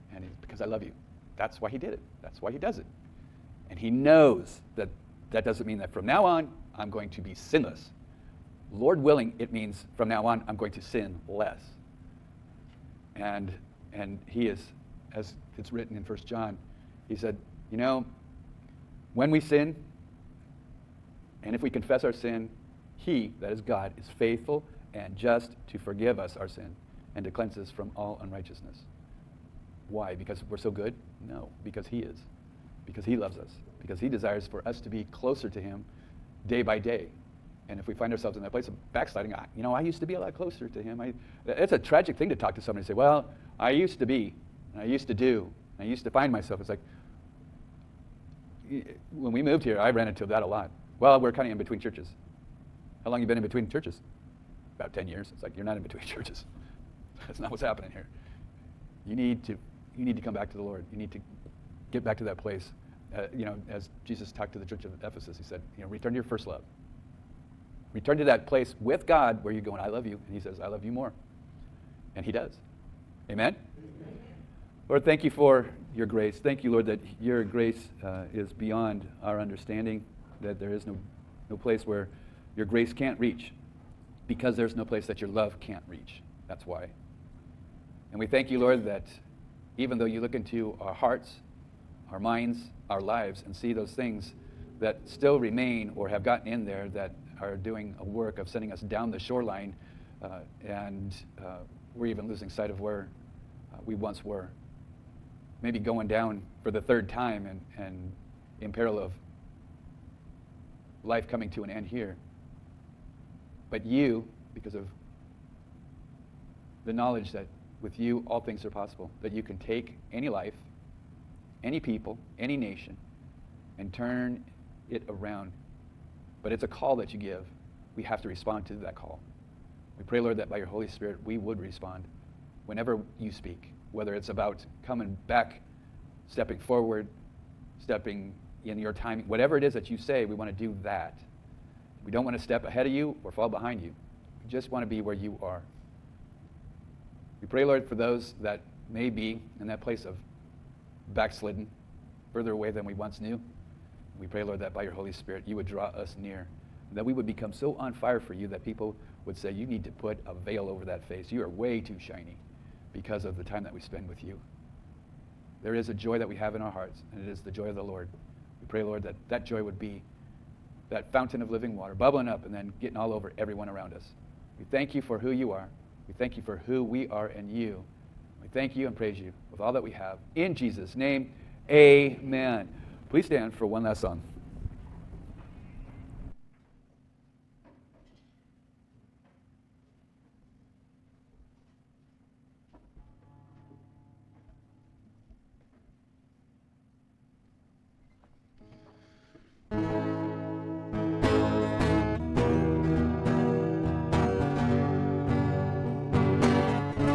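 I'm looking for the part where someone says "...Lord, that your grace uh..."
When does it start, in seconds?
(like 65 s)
76 s.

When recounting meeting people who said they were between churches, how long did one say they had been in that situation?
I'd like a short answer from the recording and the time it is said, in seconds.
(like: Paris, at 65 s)
10 years, at 54 s.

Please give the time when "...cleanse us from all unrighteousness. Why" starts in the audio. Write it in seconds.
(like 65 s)
27 s.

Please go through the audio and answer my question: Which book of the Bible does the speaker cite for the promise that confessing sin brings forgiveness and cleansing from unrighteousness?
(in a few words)
First John.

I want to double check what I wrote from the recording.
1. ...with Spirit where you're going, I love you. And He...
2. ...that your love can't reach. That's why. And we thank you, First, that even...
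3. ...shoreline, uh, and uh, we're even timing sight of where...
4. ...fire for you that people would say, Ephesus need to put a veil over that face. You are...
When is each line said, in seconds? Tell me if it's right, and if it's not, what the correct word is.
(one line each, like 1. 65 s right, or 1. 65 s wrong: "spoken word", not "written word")
1. 68 s wrong: "God", not "Spirit"
2. 85 s wrong: "Lord", not "First"
3. 99 s wrong: "losing", not "timing"
4. 157 s wrong: "You", not "Ephesus".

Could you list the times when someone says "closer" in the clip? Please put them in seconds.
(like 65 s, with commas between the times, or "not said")
35 s, 40 s.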